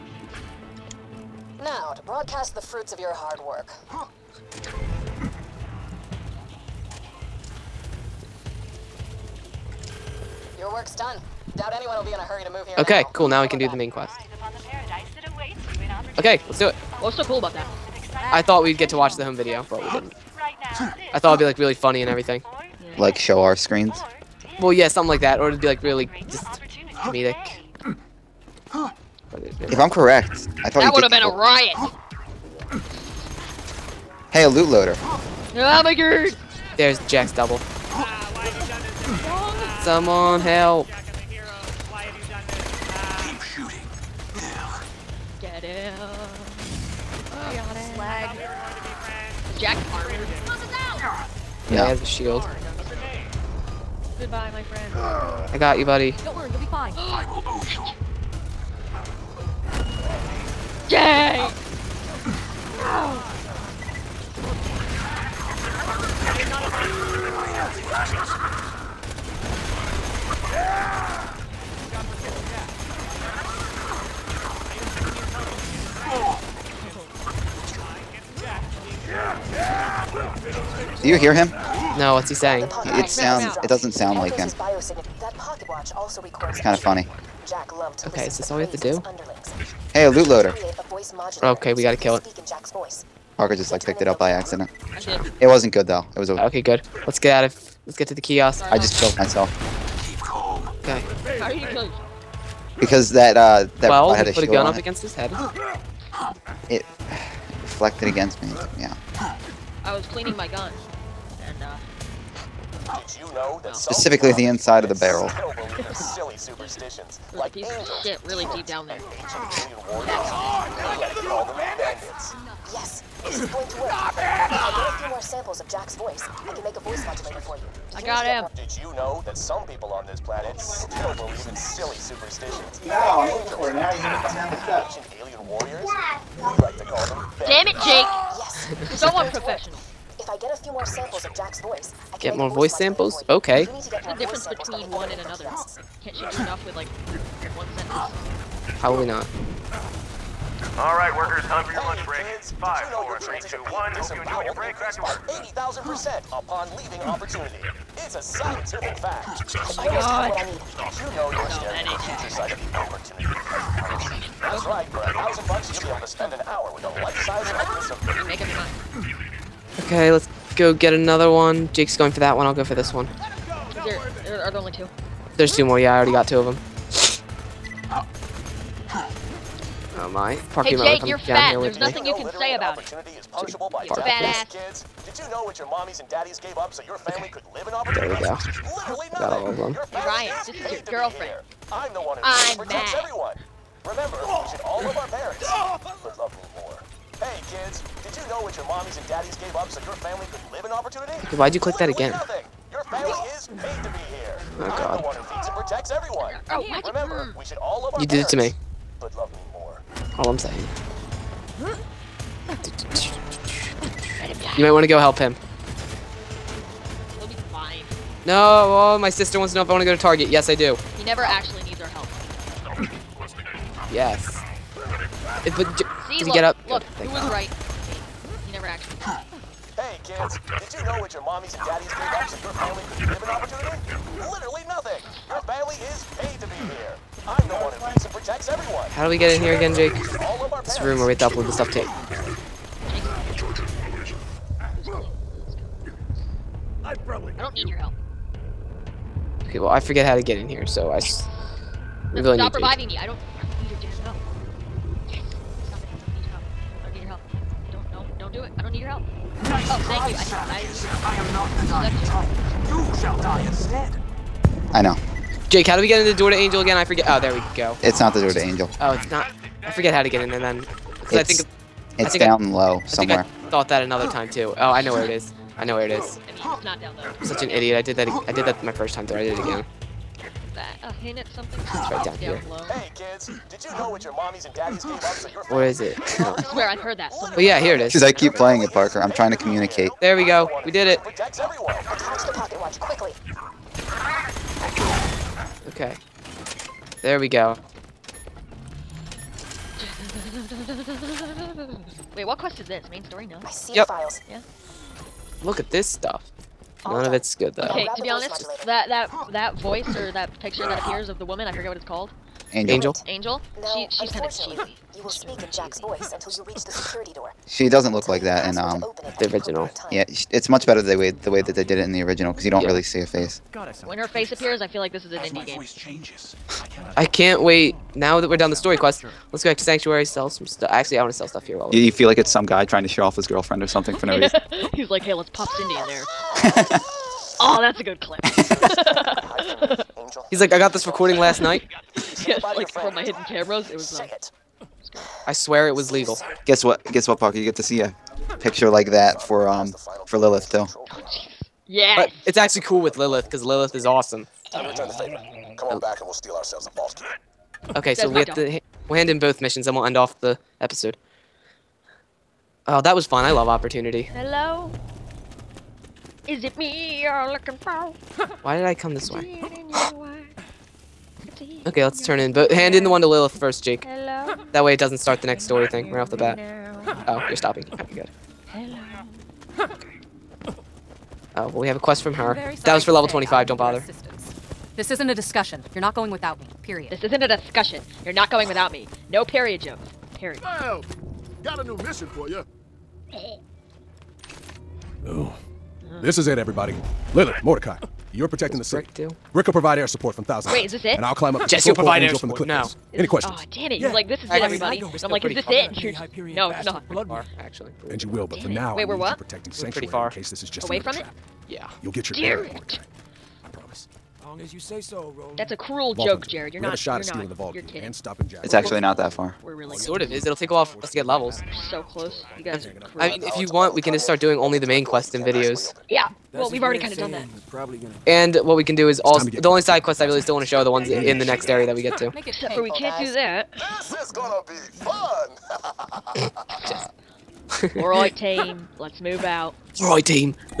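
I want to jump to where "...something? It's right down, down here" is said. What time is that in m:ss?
4:41.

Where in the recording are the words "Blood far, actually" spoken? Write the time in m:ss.
6:46.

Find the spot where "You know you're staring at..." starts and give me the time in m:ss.
2:40.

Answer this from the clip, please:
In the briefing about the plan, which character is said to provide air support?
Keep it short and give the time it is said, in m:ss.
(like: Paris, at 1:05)
Brick, at 6:39.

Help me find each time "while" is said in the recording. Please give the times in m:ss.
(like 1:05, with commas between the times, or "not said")
5:31, 7:00.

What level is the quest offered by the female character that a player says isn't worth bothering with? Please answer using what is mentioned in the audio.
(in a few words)
25.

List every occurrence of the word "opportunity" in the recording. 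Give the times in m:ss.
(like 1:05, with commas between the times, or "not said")
2:37, 2:42, 3:07, 3:20, 3:53, 6:03.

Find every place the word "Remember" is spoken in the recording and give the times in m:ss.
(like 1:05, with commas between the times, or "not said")
3:13, 3:26.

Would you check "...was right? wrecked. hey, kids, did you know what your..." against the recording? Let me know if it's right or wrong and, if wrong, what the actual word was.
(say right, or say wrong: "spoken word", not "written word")
right.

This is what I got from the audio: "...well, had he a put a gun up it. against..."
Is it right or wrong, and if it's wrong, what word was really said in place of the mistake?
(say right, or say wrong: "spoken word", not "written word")
right.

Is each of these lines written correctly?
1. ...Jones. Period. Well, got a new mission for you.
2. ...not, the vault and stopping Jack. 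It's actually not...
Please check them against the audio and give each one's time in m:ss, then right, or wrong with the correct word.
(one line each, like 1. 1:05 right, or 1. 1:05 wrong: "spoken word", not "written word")
1. 6:29 right
2. 6:57 right.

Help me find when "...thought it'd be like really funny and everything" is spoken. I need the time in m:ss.
0:21.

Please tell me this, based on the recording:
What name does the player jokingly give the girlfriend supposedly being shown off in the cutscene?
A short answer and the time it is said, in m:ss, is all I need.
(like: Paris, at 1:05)
Cindy, at 5:35.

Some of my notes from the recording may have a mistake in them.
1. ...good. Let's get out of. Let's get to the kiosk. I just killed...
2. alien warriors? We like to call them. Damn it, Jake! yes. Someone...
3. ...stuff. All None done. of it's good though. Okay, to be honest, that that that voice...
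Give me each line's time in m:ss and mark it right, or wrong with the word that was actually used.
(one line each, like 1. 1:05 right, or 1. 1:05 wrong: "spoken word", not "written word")
1. 1:36 right
2. 2:15 right
3. 5:05 right.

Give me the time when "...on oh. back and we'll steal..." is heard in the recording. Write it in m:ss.
5:55.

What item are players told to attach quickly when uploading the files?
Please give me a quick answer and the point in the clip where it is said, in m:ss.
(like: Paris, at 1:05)
Pocket watch, at 4:52.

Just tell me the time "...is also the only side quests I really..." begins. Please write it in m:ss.
7:08.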